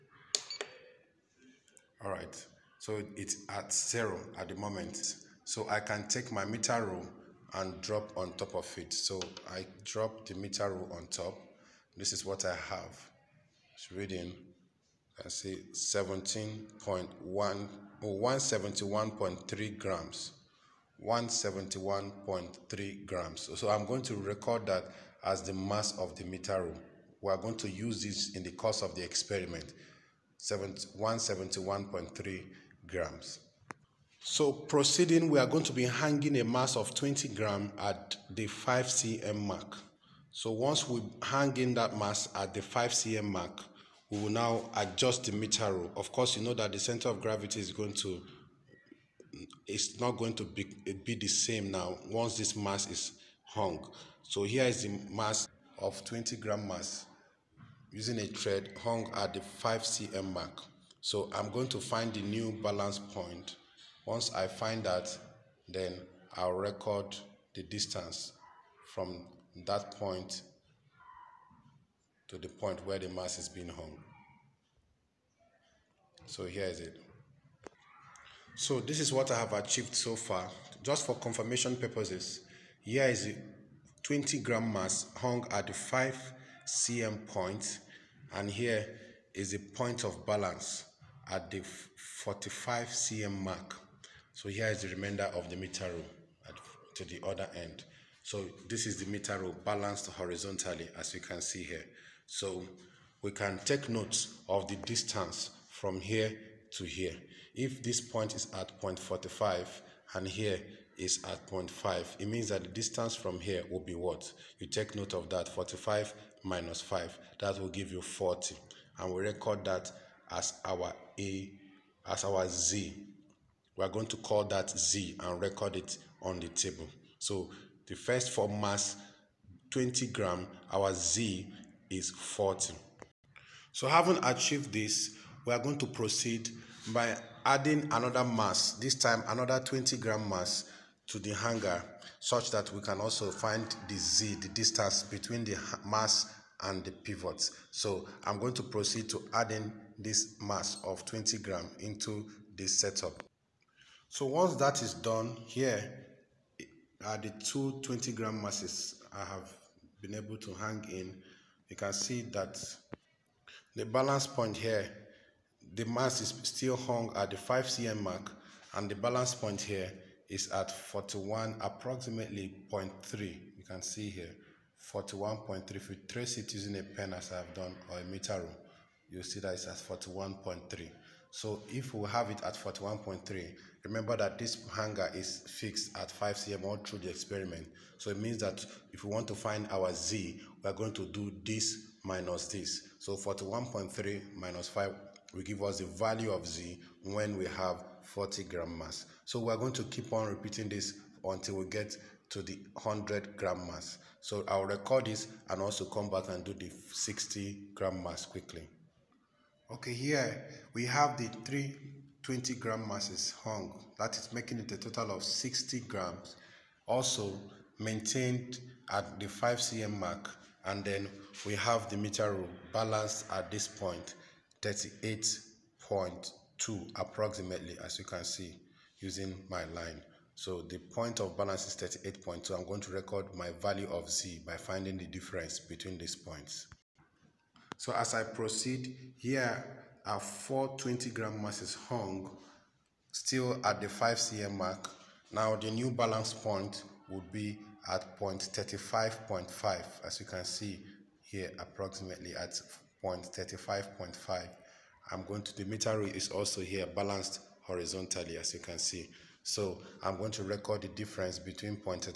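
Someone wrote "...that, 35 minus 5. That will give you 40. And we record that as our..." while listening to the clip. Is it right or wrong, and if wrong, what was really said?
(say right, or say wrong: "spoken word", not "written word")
wrong: "45", not "35".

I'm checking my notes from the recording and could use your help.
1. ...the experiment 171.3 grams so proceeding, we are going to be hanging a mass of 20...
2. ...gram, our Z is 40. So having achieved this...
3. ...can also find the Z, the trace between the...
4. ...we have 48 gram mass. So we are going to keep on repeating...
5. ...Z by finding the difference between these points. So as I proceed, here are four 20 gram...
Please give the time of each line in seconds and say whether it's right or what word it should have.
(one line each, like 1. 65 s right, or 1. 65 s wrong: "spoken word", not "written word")
1. 28 s right
2. 130 s right
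3. 142 s wrong: "distance", not "trace"
4. 197 s wrong: "40", not "48"
5. 234 s right.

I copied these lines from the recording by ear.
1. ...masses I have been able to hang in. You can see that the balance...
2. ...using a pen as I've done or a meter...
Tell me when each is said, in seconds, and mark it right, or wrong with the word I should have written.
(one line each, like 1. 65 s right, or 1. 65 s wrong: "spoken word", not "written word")
1. 158 s right
2. 176 s right.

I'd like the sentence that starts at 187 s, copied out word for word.
So it means that if we want to find our z, we are going to do this minus this.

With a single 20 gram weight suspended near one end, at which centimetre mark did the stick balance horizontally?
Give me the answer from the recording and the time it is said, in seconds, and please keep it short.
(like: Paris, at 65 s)
45 cm, at 92 s.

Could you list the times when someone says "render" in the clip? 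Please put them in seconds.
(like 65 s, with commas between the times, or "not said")
not said.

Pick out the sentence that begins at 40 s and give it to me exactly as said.
So once we hang in that mass at the 5 cm mark, we will now adjust the meter rule.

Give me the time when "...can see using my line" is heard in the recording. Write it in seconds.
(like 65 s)
228 s.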